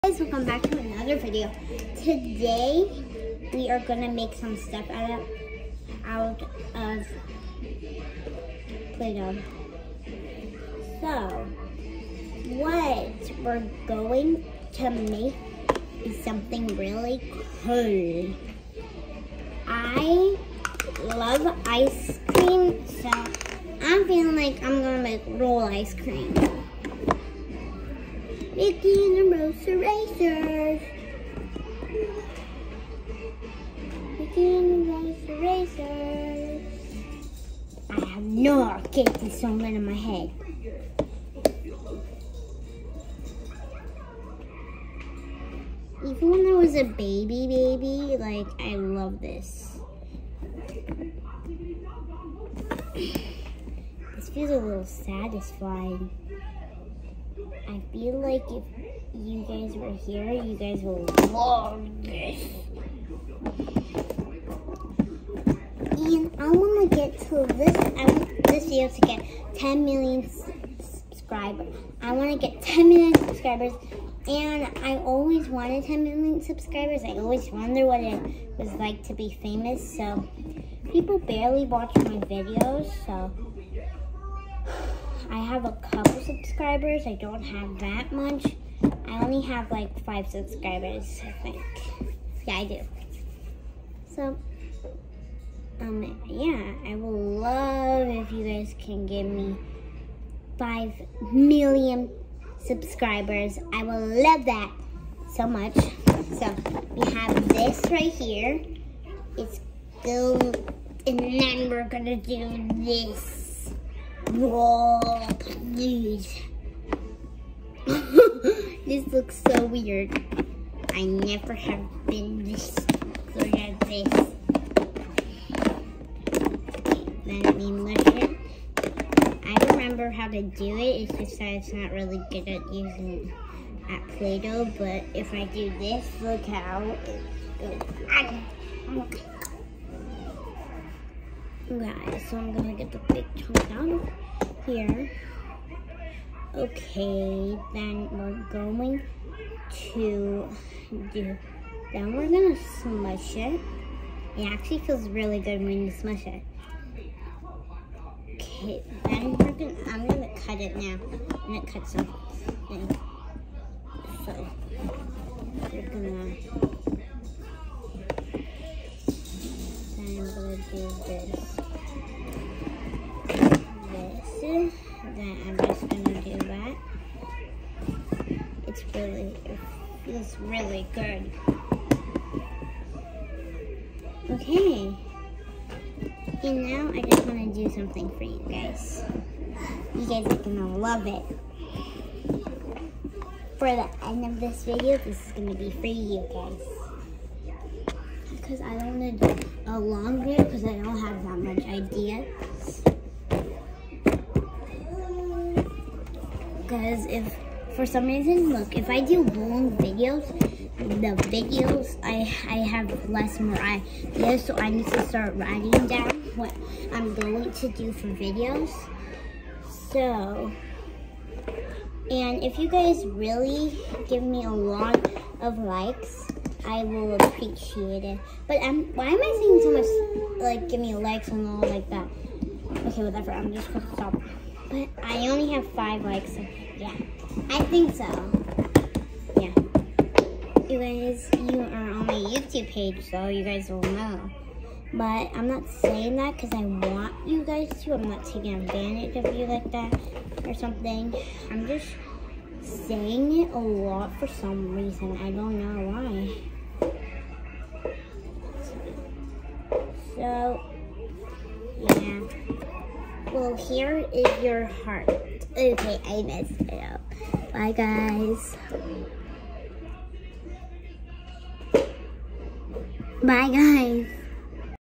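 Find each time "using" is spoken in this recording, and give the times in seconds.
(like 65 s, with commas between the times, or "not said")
132 s.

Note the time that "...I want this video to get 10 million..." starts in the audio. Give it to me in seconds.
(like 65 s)
67 s.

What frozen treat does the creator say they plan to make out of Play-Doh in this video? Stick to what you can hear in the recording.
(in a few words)
roll ice cream.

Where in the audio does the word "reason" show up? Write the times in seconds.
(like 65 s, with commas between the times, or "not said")
208 s, 254 s.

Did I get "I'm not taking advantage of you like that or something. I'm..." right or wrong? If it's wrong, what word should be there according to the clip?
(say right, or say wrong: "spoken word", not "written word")
right.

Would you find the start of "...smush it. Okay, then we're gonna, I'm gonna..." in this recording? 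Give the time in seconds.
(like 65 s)
155 s.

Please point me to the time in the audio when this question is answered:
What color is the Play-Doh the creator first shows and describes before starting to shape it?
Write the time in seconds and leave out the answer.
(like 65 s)
110 s.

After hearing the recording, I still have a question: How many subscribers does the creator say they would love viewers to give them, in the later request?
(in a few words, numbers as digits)
5 million.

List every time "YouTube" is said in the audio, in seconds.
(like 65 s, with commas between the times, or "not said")
242 s.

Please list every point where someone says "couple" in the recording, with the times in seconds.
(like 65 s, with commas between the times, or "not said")
85 s.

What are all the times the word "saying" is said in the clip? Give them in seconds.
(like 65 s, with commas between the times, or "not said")
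229 s, 245 s, 252 s.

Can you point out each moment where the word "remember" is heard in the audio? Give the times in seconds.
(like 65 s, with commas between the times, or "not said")
129 s.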